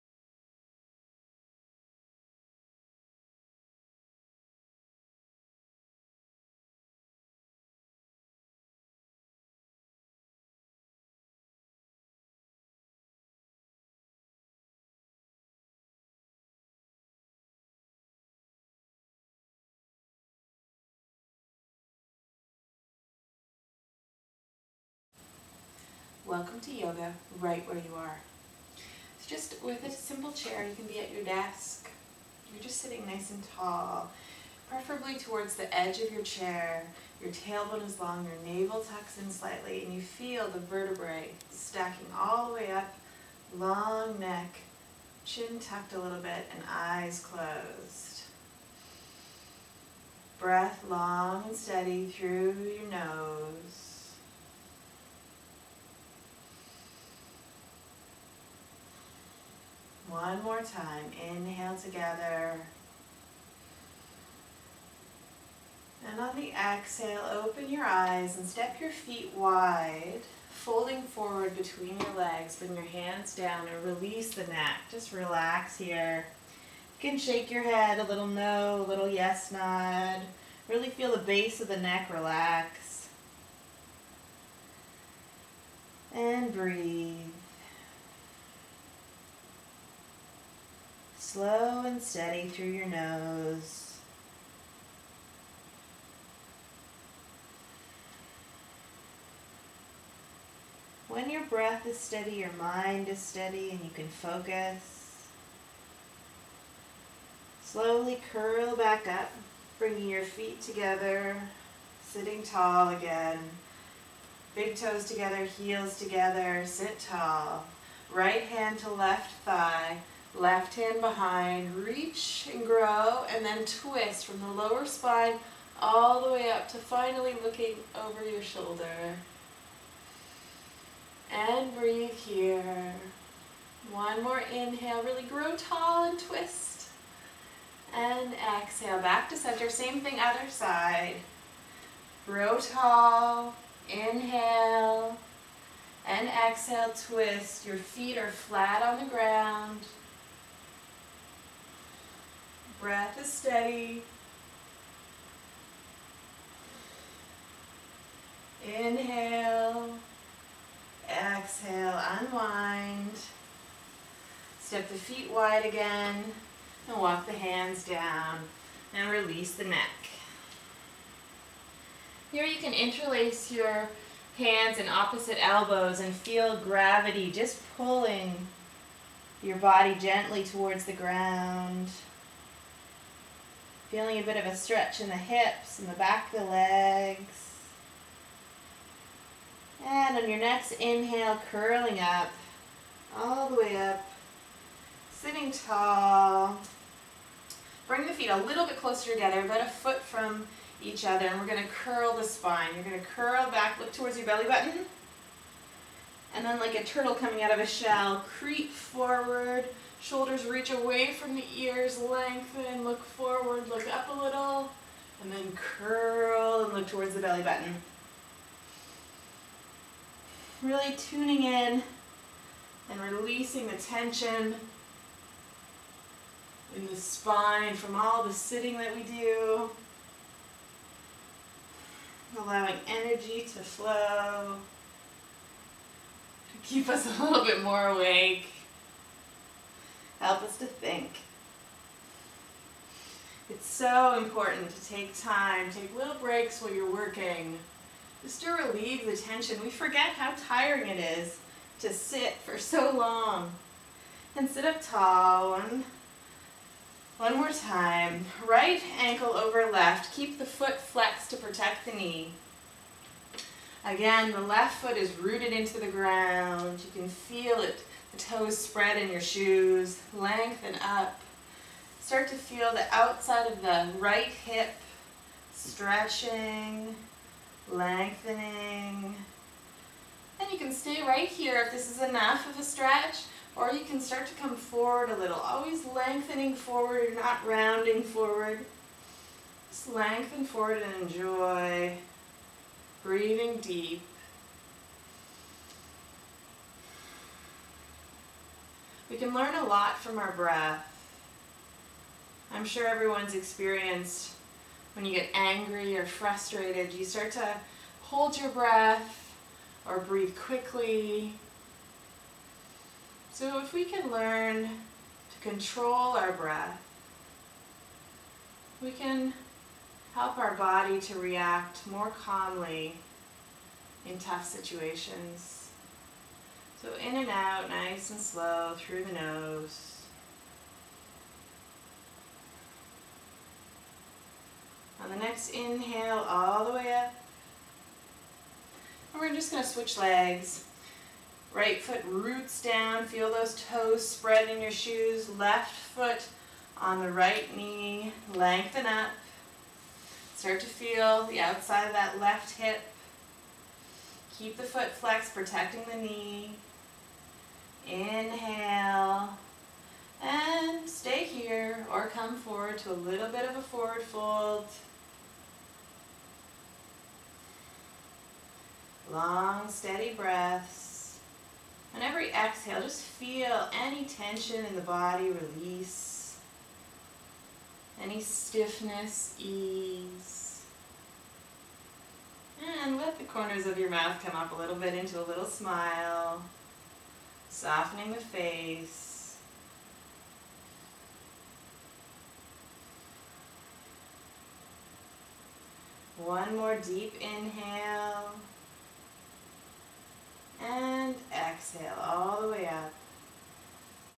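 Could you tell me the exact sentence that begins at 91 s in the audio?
slow and steady through your nose.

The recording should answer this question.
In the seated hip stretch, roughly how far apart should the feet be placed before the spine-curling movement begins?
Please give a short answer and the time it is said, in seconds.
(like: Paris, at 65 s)
About a foot, at 199 s.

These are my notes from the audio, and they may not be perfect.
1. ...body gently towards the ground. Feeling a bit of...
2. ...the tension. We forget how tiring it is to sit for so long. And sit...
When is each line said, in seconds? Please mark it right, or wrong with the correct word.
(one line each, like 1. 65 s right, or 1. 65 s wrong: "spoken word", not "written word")
1. 179 s right
2. 249 s right.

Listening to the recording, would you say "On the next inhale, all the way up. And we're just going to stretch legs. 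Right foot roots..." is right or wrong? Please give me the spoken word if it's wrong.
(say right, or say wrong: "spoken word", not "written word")
wrong: "switch", not "stretch".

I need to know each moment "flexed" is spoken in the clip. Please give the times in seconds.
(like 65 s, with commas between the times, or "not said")
260 s, 354 s.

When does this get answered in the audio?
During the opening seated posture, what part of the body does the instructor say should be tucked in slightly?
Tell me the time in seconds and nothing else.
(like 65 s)
38 s.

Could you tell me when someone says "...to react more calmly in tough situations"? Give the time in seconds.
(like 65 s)
321 s.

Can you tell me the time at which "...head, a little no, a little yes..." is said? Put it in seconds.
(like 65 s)
77 s.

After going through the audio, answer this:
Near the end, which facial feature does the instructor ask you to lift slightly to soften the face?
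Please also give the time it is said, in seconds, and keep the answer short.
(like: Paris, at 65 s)
Corners of your mouth, at 383 s.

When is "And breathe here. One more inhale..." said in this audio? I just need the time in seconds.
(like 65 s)
131 s.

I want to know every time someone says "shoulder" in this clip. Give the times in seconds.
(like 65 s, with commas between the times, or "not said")
128 s, 210 s.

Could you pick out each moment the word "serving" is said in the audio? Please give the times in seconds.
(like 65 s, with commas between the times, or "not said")
not said.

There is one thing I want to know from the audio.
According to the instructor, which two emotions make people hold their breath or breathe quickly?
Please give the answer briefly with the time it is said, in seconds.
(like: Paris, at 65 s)
Angry or frustrated, at 305 s.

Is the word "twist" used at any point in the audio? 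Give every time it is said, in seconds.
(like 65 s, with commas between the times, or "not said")
123 s, 136 s, 147 s.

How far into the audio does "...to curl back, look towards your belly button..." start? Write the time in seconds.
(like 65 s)
203 s.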